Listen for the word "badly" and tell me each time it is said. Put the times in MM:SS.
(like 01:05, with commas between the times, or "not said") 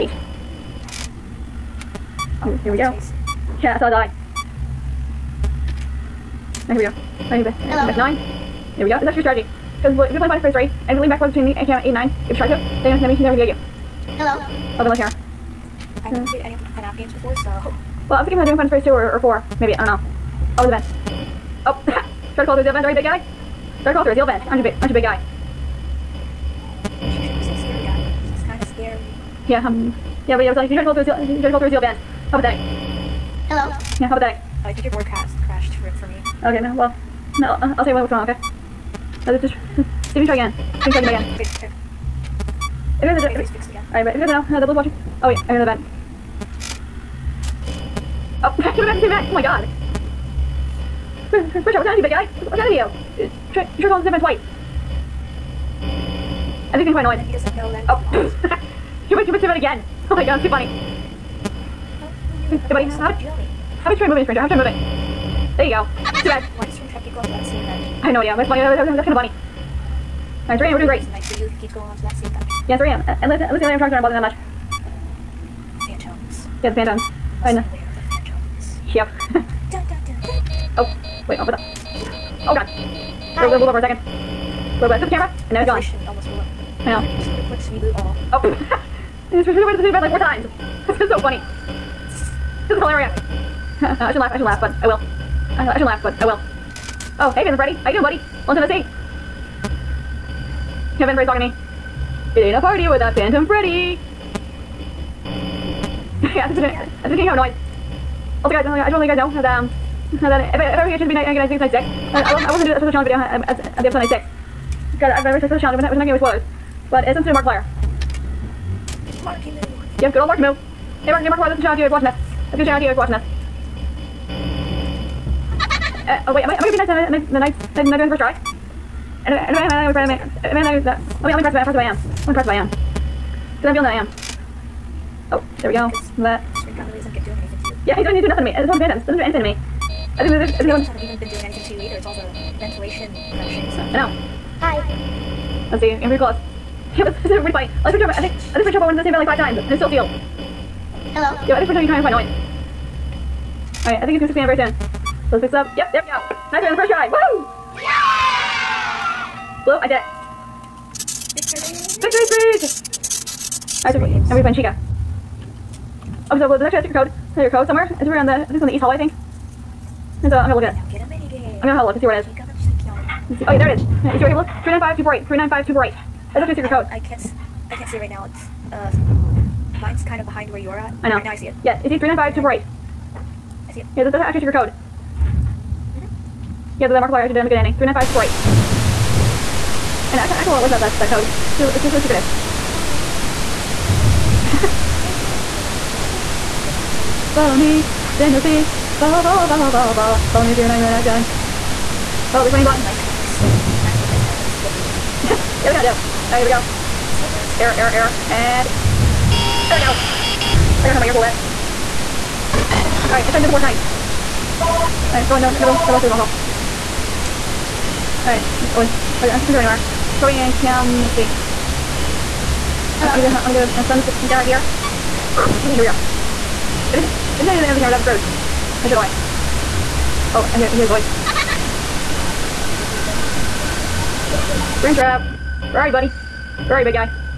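not said.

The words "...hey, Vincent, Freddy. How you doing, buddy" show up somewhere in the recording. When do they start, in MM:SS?
01:37.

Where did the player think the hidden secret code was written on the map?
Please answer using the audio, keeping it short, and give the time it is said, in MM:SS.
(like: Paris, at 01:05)
east hallway, at 02:48.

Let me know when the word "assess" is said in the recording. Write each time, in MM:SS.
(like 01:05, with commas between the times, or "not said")
not said.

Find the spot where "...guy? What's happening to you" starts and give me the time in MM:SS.
00:52.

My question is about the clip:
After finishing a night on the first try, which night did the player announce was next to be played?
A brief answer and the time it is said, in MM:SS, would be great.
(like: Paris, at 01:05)
fourth night, at 03:33.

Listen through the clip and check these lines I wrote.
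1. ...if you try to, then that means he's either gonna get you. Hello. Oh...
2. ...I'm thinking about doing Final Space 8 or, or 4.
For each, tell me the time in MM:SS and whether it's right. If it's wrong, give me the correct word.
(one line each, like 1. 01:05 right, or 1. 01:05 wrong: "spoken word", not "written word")
1. 00:12 wrong: "never", not "either"
2. 00:18 wrong: "2", not "8".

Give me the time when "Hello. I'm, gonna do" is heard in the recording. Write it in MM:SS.
03:42.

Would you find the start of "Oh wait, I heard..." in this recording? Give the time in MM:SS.
00:45.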